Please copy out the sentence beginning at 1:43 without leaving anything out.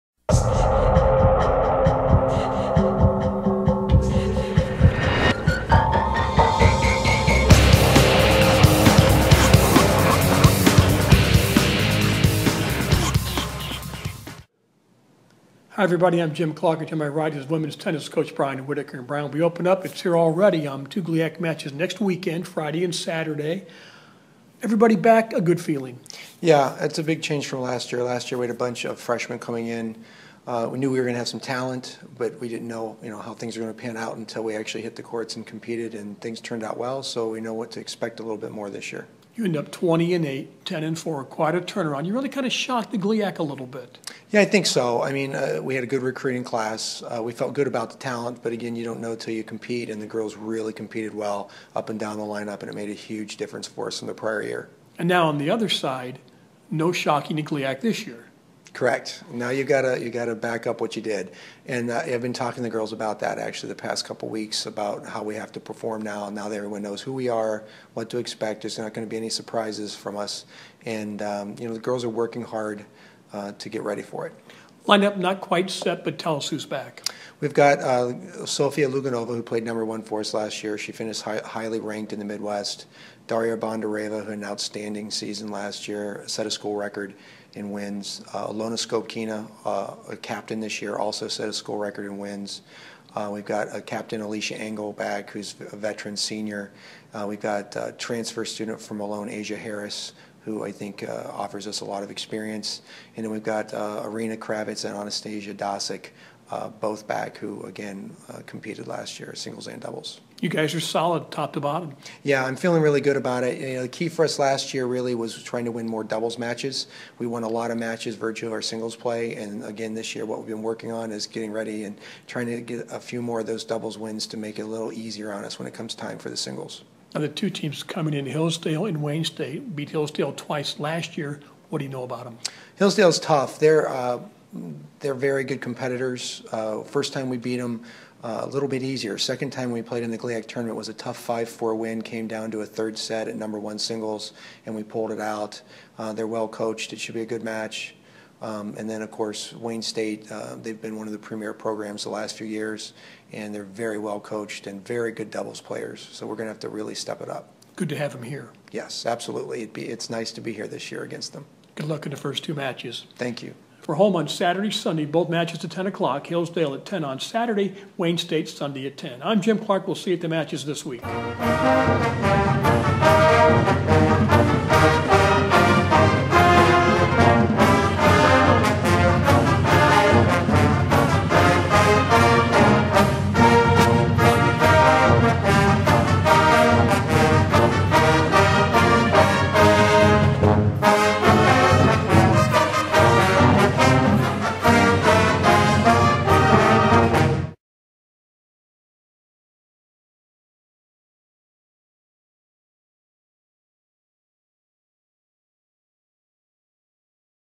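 And then we've got uh, Arena Kravitz and Anastasia Dasik uh, both back, who again uh, competed last year, singles and doubles.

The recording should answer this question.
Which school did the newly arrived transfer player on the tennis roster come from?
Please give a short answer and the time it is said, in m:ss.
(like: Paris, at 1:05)
Malone, at 1:38.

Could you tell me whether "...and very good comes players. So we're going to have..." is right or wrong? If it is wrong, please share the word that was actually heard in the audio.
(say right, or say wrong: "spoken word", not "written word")
wrong: "doubles", not "comes".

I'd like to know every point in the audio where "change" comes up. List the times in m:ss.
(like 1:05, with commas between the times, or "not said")
0:27.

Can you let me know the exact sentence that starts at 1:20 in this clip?
She finished high, highly ranked in the Midwest.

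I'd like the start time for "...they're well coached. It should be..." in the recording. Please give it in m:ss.
2:26.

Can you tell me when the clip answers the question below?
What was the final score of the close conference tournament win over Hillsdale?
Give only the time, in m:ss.
2:21.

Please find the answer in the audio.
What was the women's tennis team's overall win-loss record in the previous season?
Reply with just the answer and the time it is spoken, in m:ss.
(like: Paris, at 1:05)
20-8, at 0:39.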